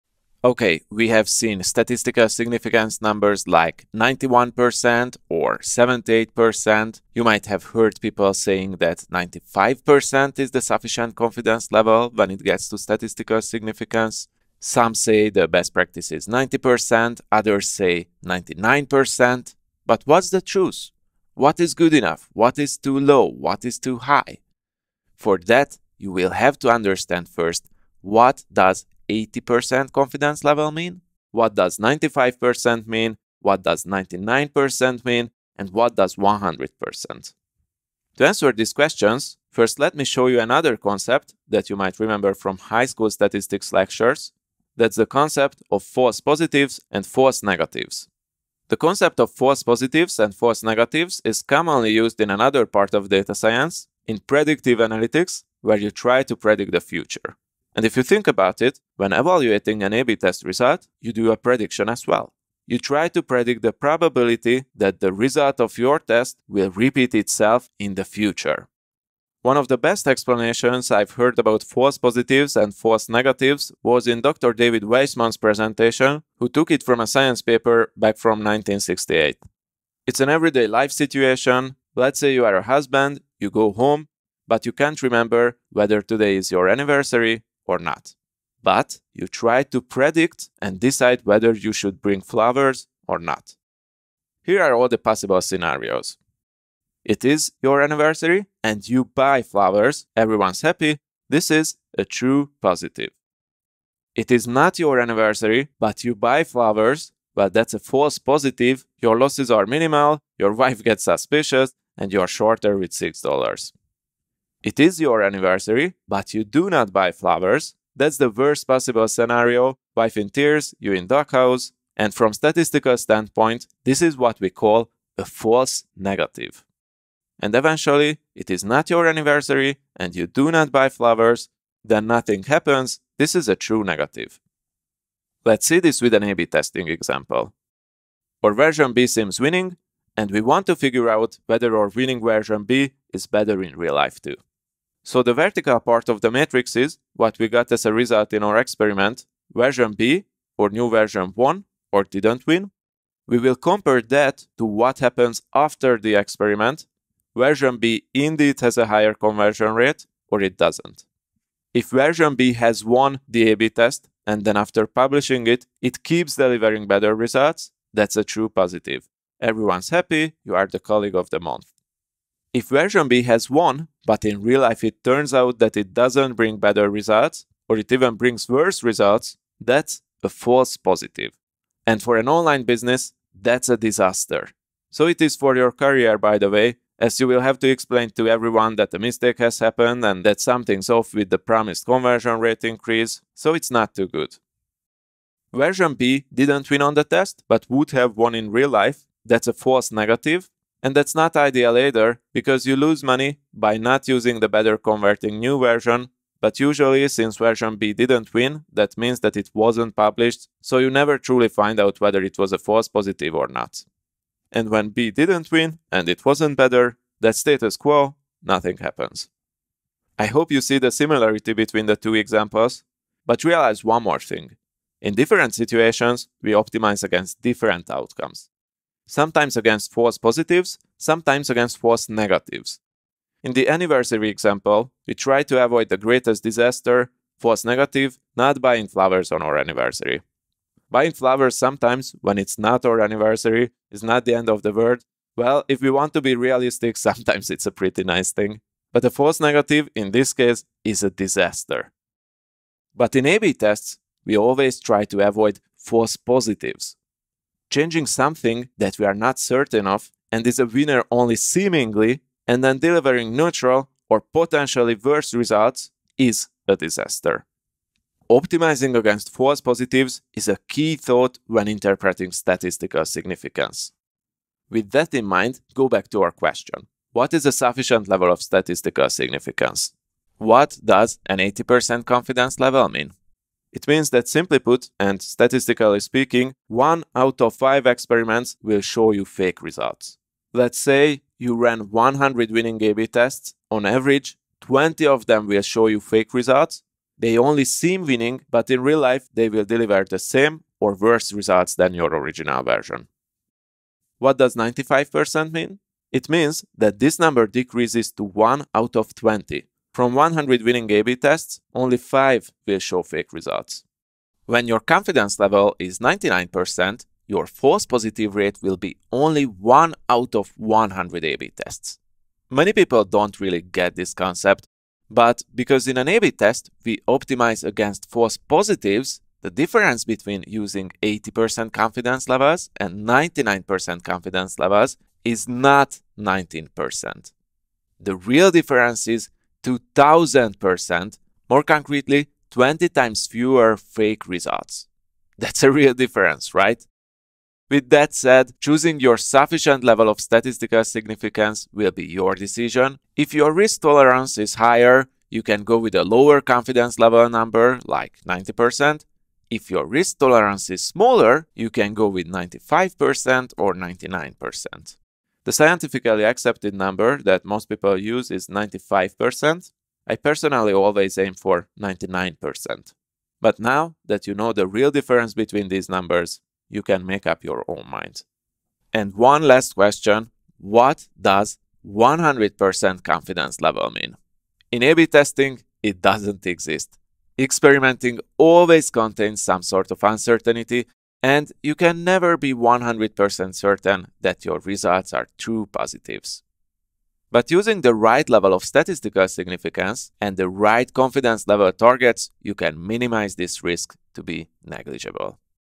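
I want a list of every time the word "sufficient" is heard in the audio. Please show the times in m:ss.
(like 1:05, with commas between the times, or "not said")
0:10, 4:37, 5:49.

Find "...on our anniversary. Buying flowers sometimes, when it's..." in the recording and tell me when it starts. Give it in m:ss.
3:59.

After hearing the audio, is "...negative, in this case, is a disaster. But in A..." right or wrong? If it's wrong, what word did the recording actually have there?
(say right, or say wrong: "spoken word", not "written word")
right.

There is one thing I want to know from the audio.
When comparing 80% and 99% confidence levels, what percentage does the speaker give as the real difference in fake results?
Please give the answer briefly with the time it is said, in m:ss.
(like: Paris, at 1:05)
2000%, at 5:39.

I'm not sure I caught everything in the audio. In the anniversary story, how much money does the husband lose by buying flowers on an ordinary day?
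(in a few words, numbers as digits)
$6.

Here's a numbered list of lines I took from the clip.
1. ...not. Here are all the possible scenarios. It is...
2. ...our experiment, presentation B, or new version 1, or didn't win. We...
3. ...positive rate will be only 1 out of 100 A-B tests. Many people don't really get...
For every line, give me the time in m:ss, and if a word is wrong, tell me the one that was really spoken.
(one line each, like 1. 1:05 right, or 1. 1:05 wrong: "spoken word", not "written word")
1. 1:33 right
2. 2:28 wrong: "version", not "presentation"
3. 5:17 right.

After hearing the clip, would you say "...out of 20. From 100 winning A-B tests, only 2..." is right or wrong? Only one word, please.
wrong.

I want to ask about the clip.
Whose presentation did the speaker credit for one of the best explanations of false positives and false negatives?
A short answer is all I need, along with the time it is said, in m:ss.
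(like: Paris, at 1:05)
Dr. David Weisman, at 1:14.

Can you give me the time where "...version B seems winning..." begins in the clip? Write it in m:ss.
2:18.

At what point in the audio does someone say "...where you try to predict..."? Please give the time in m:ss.
0:55.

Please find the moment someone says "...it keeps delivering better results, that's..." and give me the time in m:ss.
2:45.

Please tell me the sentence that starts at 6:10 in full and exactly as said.
I personally always aim for 99%.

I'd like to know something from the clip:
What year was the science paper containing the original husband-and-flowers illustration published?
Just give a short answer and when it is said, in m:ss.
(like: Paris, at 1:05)
1968, at 1:18.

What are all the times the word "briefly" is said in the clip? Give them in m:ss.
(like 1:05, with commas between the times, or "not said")
not said.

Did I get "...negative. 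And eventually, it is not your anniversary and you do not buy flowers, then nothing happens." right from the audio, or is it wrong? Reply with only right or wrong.
right.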